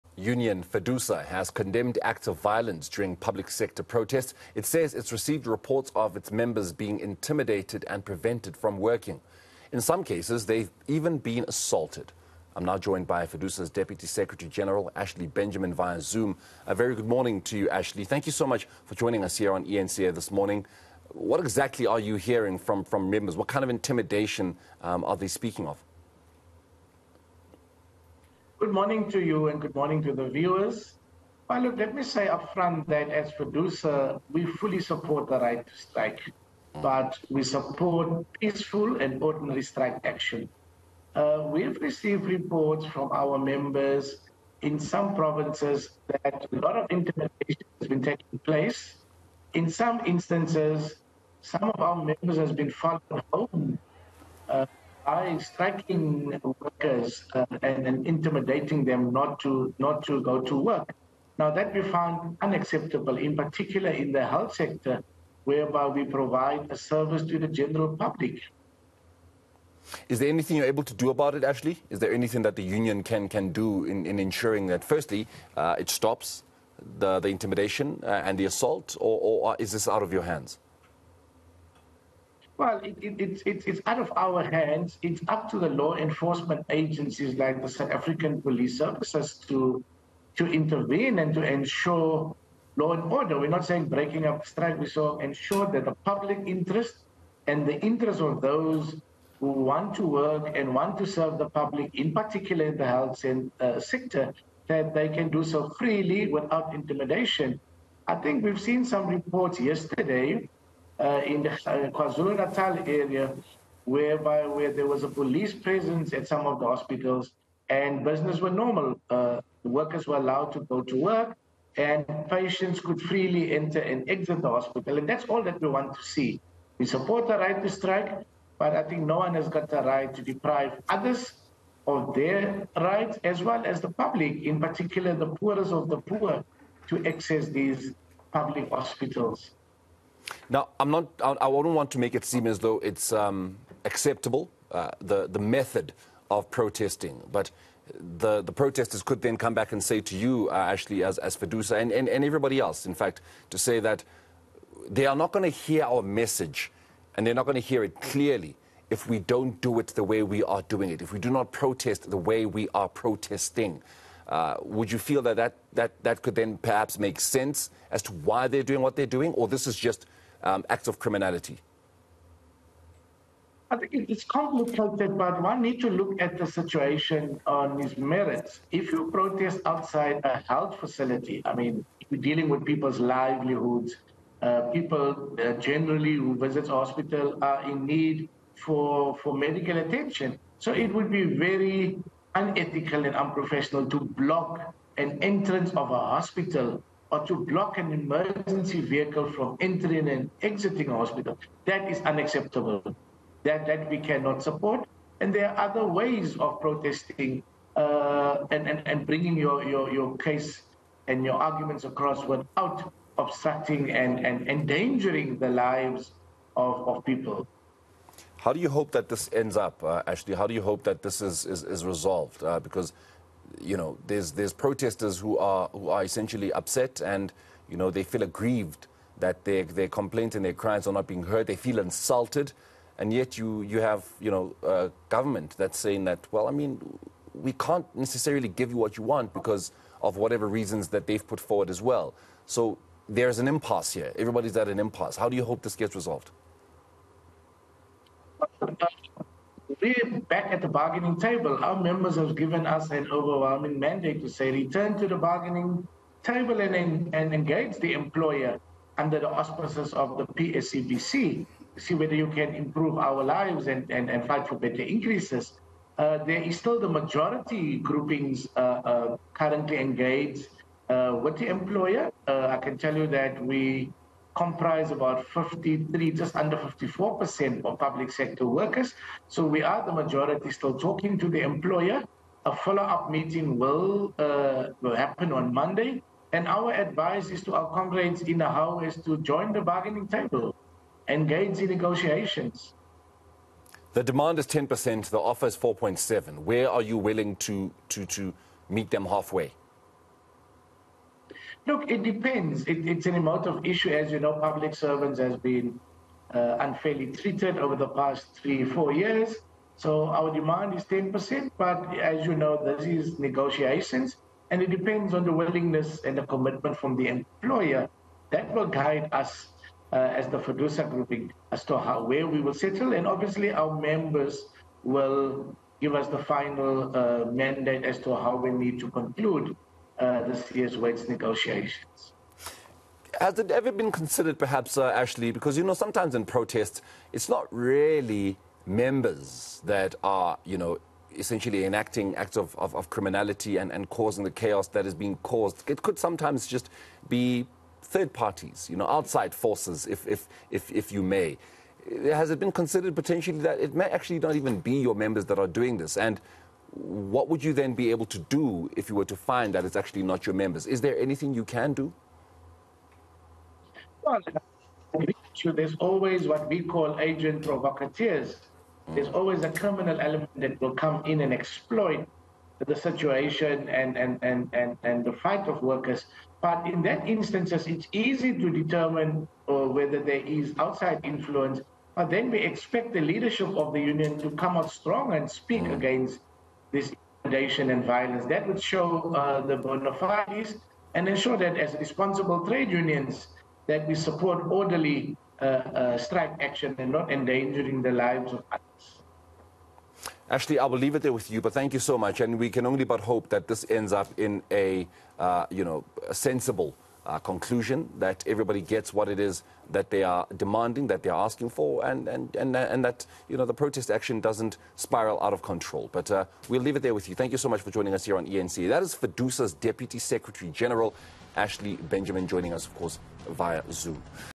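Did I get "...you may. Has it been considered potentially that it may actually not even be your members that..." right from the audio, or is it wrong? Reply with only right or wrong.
right.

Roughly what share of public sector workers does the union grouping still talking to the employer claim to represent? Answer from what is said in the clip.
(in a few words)
just under 54%.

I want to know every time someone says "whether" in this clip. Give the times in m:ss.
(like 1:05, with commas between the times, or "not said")
4:21, 6:19.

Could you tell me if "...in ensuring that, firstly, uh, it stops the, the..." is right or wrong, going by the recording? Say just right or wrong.
right.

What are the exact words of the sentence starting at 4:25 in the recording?
Uh, there is still the majority groupings uh, uh, currently engaged uh, with the employer.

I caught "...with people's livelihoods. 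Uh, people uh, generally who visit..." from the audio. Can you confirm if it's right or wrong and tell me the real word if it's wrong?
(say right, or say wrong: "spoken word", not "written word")
right.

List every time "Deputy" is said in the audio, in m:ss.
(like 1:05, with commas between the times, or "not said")
0:13, 6:59.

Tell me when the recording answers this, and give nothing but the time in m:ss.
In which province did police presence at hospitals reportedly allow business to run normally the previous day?
1:51.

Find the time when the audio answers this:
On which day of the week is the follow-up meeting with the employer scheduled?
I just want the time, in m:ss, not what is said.
4:45.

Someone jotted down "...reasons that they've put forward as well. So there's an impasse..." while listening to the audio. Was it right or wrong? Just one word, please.
right.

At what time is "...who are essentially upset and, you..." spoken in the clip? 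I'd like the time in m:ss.
3:45.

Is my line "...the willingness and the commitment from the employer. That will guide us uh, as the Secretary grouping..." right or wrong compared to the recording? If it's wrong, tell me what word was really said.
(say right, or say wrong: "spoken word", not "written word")
wrong: "FEDUSA", not "Secretary".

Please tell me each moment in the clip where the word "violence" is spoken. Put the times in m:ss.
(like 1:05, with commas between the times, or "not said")
0:02, 6:27.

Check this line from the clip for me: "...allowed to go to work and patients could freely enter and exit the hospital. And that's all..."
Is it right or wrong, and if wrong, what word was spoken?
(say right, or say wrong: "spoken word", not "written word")
right.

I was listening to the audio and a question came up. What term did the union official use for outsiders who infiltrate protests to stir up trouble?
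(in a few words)
agent provocateurs.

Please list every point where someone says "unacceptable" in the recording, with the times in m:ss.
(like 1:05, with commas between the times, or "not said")
1:02, 3:22.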